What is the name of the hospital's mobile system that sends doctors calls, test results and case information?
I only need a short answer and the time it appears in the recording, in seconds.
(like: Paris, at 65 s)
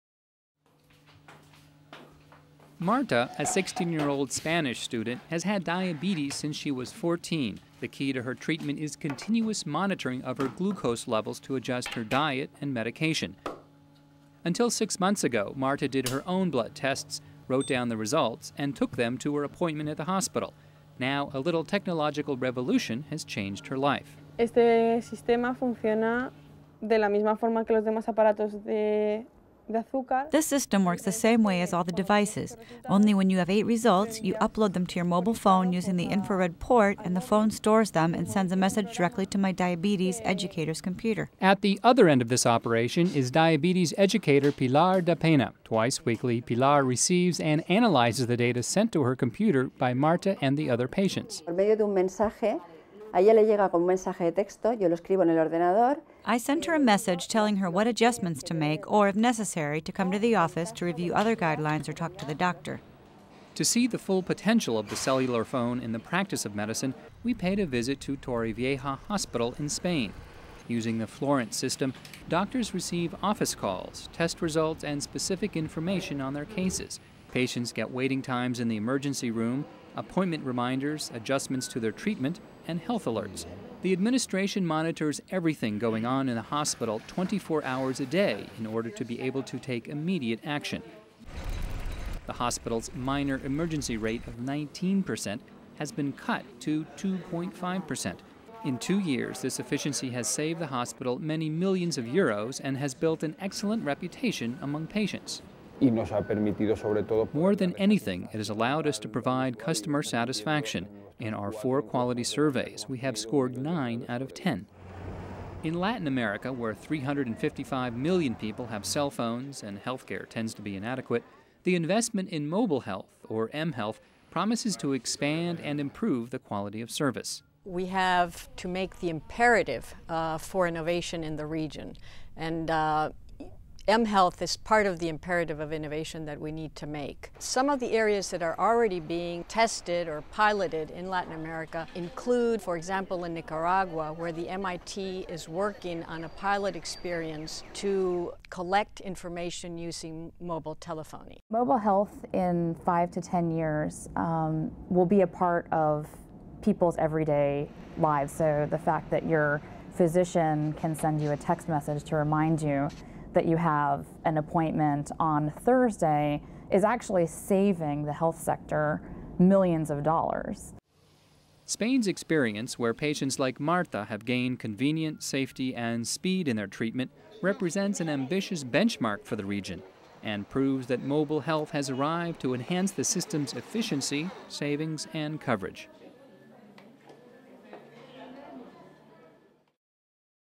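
Florence, at 71 s.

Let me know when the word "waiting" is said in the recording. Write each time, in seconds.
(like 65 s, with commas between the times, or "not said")
77 s.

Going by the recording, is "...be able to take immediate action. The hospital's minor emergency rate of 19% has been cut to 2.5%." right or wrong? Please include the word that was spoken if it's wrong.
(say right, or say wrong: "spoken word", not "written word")
right.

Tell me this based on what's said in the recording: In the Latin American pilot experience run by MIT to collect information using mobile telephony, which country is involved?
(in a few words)
Nicaragua.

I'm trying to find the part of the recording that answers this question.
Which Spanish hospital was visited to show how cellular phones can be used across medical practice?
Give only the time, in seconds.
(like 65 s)
68 s.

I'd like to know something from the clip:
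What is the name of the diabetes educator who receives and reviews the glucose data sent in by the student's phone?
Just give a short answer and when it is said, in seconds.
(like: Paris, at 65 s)
Pilar Da Pena, at 44 s.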